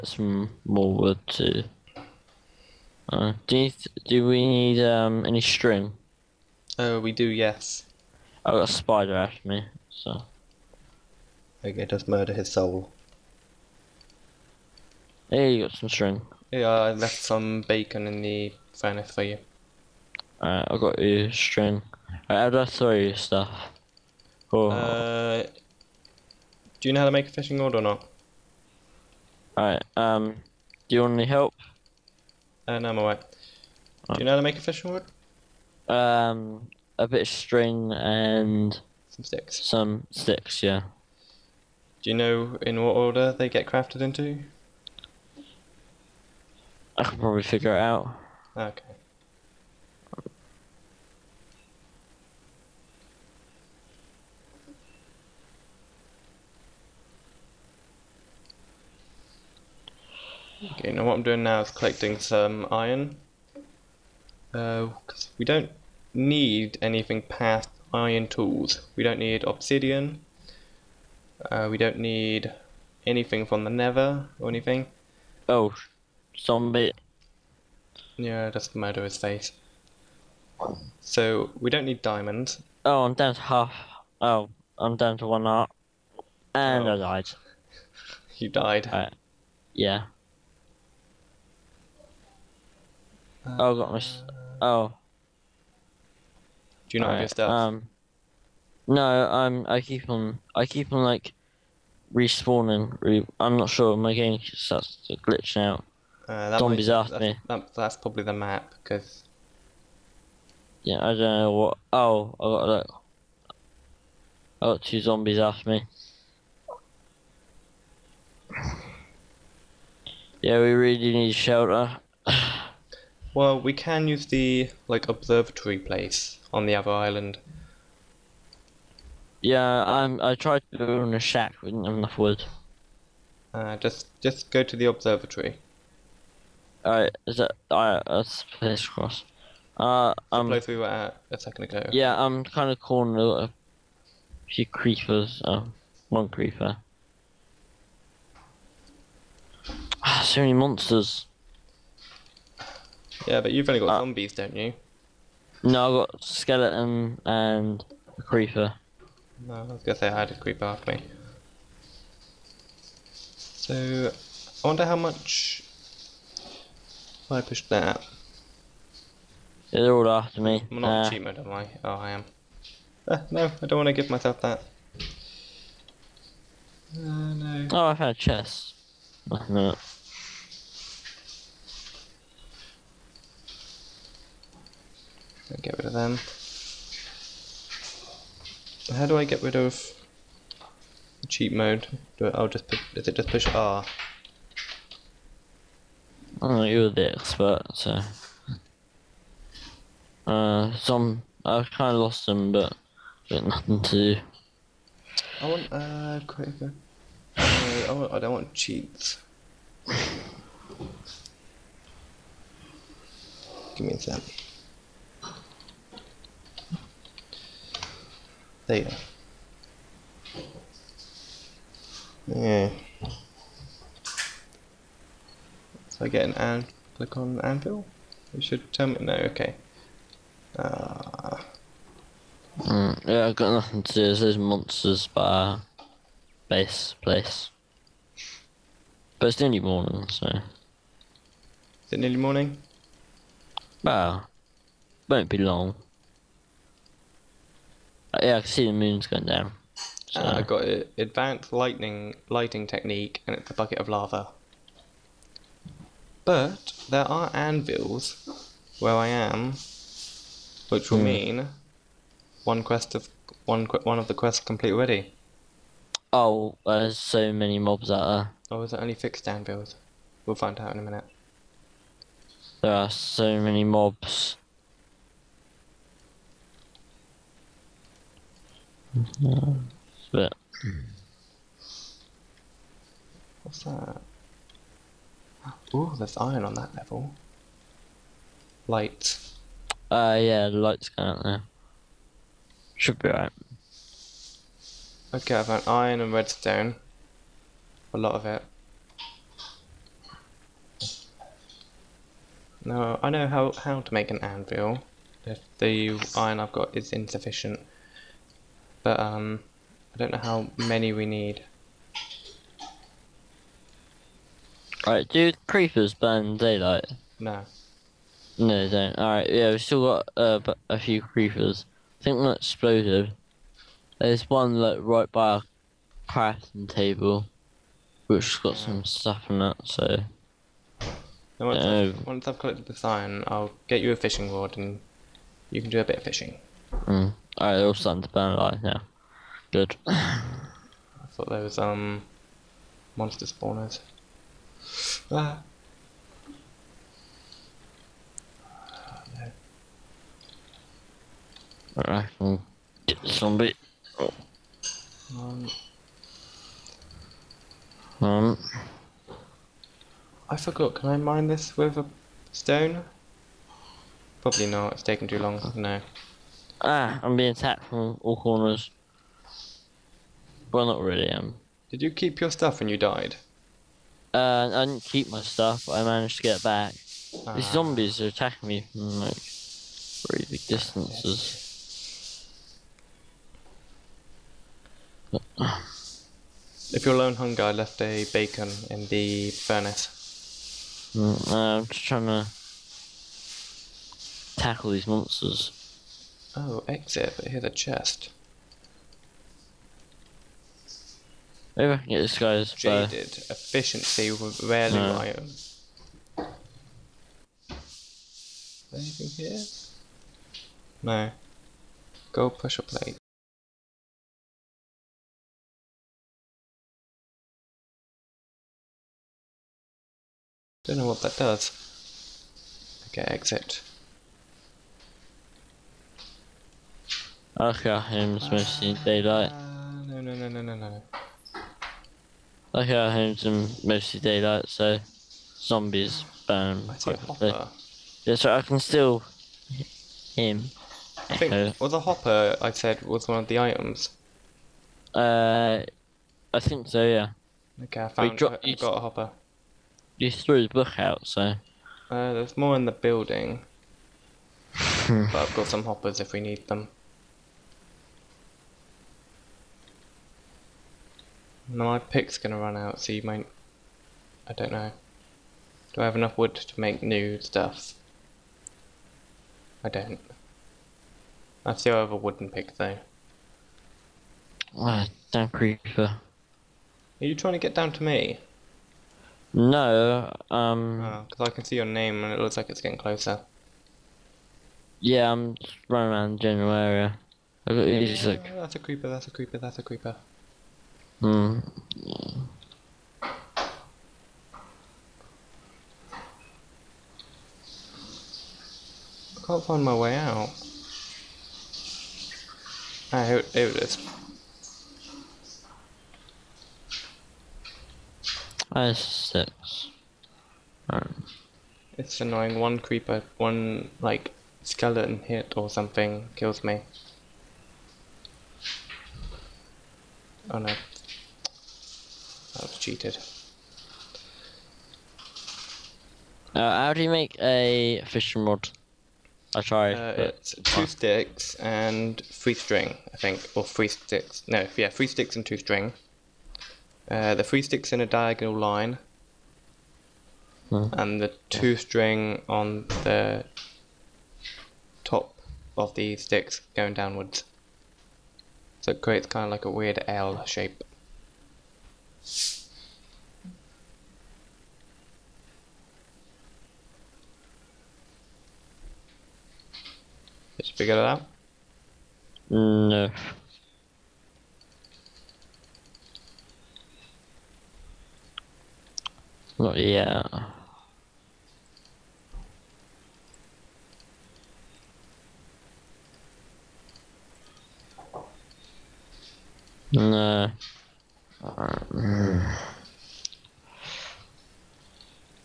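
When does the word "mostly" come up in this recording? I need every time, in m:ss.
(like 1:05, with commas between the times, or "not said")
7:13.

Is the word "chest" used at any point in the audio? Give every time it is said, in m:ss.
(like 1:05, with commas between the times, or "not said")
2:58, 6:37.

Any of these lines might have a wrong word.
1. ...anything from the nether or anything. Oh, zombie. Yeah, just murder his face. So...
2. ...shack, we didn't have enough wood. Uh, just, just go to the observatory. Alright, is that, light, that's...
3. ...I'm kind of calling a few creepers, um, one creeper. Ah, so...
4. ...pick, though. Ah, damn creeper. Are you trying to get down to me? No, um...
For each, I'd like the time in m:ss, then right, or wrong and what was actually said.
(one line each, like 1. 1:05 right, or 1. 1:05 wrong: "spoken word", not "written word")
1. 1:13 right
2. 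2:11 wrong: "alright", not "light"
3. 2:22 right
4. 7:52 right.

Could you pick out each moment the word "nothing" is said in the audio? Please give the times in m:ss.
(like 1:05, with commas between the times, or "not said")
2:59, 3:23, 3:53.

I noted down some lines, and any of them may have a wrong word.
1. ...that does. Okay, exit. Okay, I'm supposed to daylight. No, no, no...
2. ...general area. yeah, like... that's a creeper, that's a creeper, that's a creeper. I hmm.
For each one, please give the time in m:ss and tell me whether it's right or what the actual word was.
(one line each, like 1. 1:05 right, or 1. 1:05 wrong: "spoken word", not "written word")
1. 7:01 right
2. 8:06 right.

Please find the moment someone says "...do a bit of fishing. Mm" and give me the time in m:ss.
5:35.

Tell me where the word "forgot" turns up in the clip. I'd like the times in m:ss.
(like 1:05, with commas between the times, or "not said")
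6:00.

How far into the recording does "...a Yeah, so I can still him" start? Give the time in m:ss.
7:17.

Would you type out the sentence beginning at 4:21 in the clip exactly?
mean one quest of one one of the quests complete already.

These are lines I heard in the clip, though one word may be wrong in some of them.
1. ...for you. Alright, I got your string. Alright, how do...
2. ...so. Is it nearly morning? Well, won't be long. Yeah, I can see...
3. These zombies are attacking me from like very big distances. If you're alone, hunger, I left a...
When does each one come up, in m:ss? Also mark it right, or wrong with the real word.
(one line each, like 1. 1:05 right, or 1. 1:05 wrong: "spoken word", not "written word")
1. 0:19 right
2. 4:00 right
3. 6:17 right.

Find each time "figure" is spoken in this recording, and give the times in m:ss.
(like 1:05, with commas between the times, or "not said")
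0:47, 9:20.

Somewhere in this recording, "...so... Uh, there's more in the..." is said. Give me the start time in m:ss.
7:31.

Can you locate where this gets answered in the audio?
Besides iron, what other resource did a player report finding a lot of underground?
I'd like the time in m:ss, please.
4:56.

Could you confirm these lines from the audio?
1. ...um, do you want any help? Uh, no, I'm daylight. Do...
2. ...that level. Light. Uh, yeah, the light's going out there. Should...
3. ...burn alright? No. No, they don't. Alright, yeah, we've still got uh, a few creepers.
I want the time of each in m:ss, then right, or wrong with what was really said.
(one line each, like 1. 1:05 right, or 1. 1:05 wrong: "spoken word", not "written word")
1. 0:29 wrong: "alright", not "daylight"
2. 4:46 right
3. 5:15 wrong: "daylight", not "alright".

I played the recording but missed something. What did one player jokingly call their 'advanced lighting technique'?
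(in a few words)
A bucket of lava.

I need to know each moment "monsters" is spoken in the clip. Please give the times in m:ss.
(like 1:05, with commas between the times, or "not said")
2:30, 3:54, 5:42, 6:34.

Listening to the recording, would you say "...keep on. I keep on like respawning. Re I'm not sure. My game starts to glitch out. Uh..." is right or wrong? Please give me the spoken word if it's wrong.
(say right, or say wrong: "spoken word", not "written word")
right.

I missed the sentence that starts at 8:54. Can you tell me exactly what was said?
No, yeah, three sticks and two string.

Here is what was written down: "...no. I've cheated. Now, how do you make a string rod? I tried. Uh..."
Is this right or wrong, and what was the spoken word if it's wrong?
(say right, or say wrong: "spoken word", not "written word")
wrong: "fishing", not "string".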